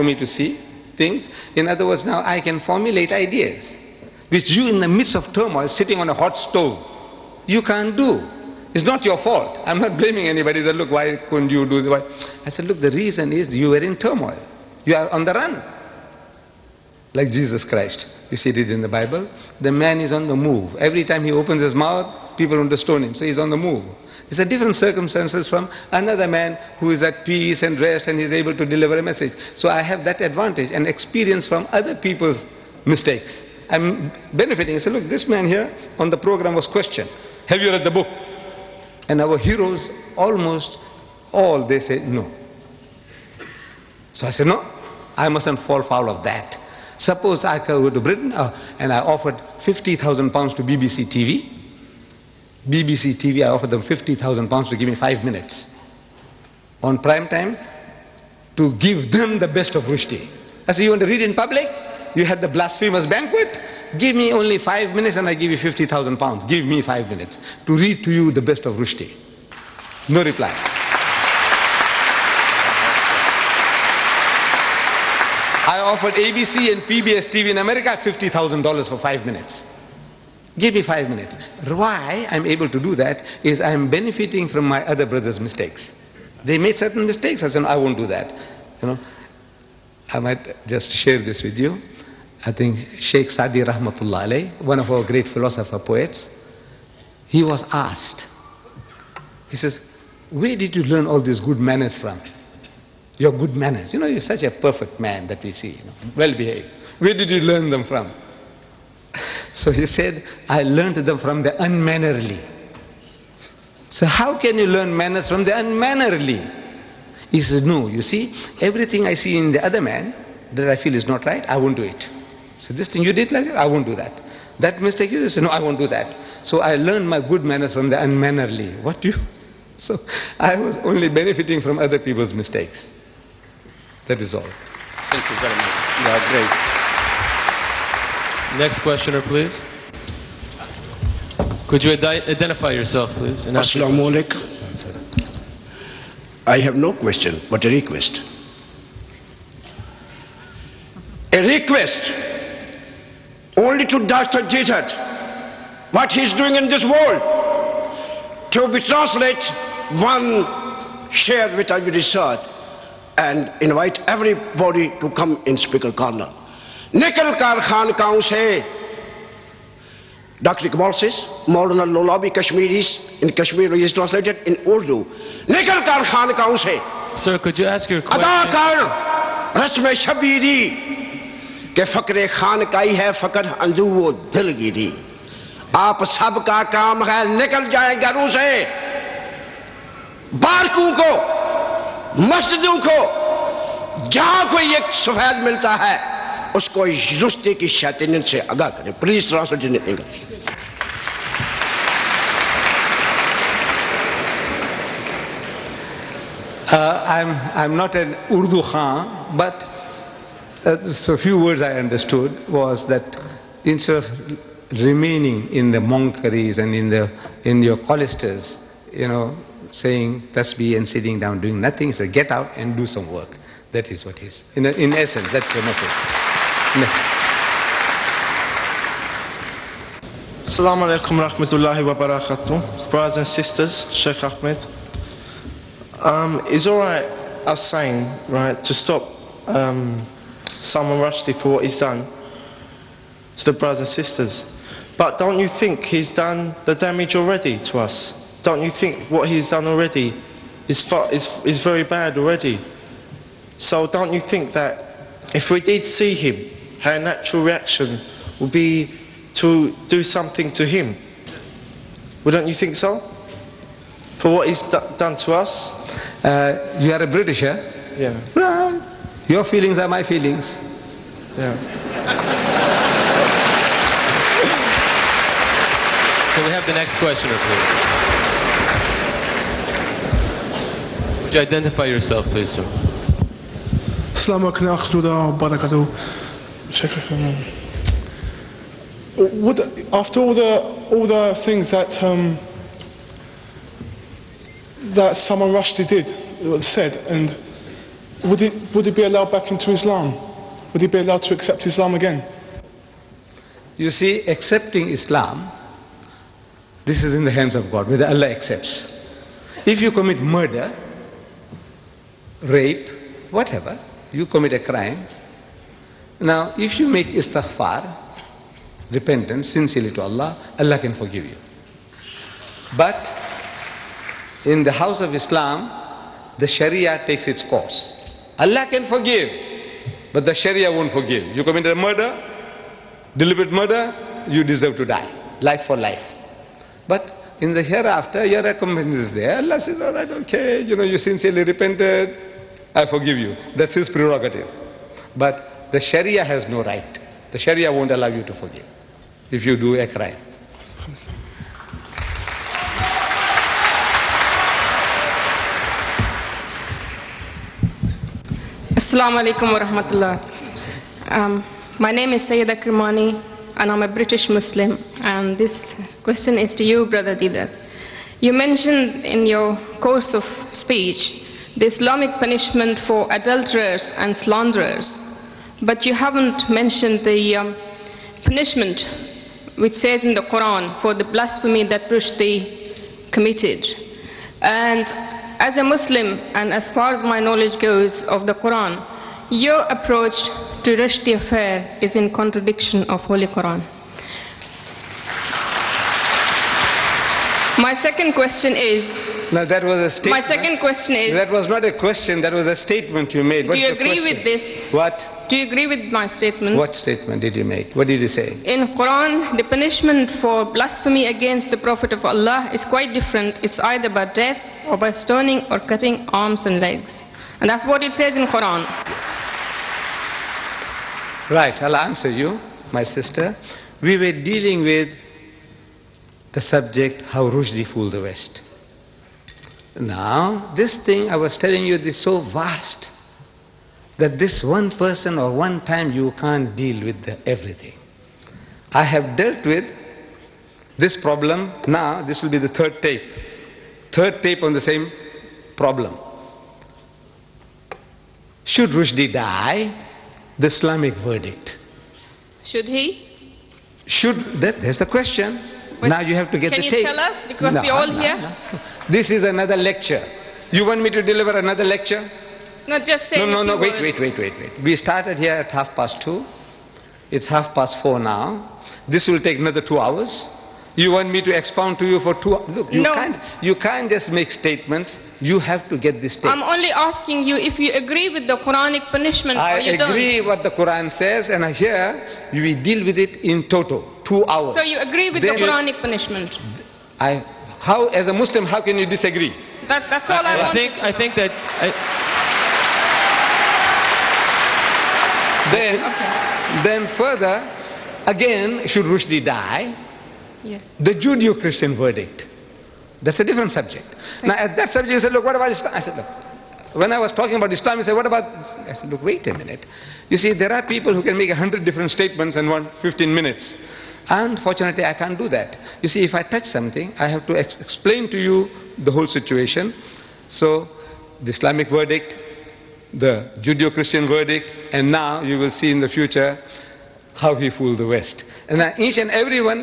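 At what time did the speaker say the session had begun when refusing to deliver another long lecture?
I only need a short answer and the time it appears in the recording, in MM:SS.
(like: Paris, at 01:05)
half past two, at 07:45.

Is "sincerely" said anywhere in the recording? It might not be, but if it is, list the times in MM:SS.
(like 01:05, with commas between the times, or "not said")
05:19, 05:40.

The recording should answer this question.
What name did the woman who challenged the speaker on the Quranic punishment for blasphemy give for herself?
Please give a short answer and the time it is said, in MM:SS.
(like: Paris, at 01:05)
Sayyida Kirmani, at 06:02.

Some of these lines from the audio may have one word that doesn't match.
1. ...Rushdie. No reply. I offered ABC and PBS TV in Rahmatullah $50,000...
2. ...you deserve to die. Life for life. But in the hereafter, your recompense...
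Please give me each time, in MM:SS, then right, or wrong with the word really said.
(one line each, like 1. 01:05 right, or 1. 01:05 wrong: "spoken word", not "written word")
1. 01:08 wrong: "America", not "Rahmatullah"
2. 05:34 right.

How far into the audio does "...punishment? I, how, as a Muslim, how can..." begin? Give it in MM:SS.
08:05.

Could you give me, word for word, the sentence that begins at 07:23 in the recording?
Third tape on the same problem.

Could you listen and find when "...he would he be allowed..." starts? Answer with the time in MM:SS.
04:58.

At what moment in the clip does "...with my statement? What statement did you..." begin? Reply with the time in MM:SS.
06:45.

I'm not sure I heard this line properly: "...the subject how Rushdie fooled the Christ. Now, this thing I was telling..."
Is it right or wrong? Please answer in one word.
wrong.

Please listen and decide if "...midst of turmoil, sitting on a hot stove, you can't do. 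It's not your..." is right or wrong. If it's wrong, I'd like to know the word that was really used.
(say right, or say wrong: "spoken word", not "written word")
right.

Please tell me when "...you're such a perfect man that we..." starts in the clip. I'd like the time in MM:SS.
01:44.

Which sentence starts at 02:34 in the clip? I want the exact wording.
Jesus, what he's doing in this world, to be translated one share with our research.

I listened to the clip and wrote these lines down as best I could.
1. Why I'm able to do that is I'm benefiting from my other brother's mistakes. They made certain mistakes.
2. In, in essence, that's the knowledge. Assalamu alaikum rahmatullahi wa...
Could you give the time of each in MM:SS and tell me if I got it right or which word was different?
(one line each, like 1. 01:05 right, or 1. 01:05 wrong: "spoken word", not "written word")
1. 01:21 right
2. 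03:44 wrong: "message", not "knowledge".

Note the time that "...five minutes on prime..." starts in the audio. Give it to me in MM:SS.
00:54.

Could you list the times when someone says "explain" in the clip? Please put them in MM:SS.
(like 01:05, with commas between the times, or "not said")
08:37.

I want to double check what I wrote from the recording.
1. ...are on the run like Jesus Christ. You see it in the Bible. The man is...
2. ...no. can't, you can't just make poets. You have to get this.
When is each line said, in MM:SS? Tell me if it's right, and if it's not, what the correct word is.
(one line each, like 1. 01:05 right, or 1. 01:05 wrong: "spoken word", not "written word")
1. 00:14 right
2. 07:52 wrong: "statements", not "poets".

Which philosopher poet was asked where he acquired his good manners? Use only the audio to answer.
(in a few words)
Sheikh Sadi.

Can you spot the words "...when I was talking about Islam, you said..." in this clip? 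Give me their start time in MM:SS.
08:26.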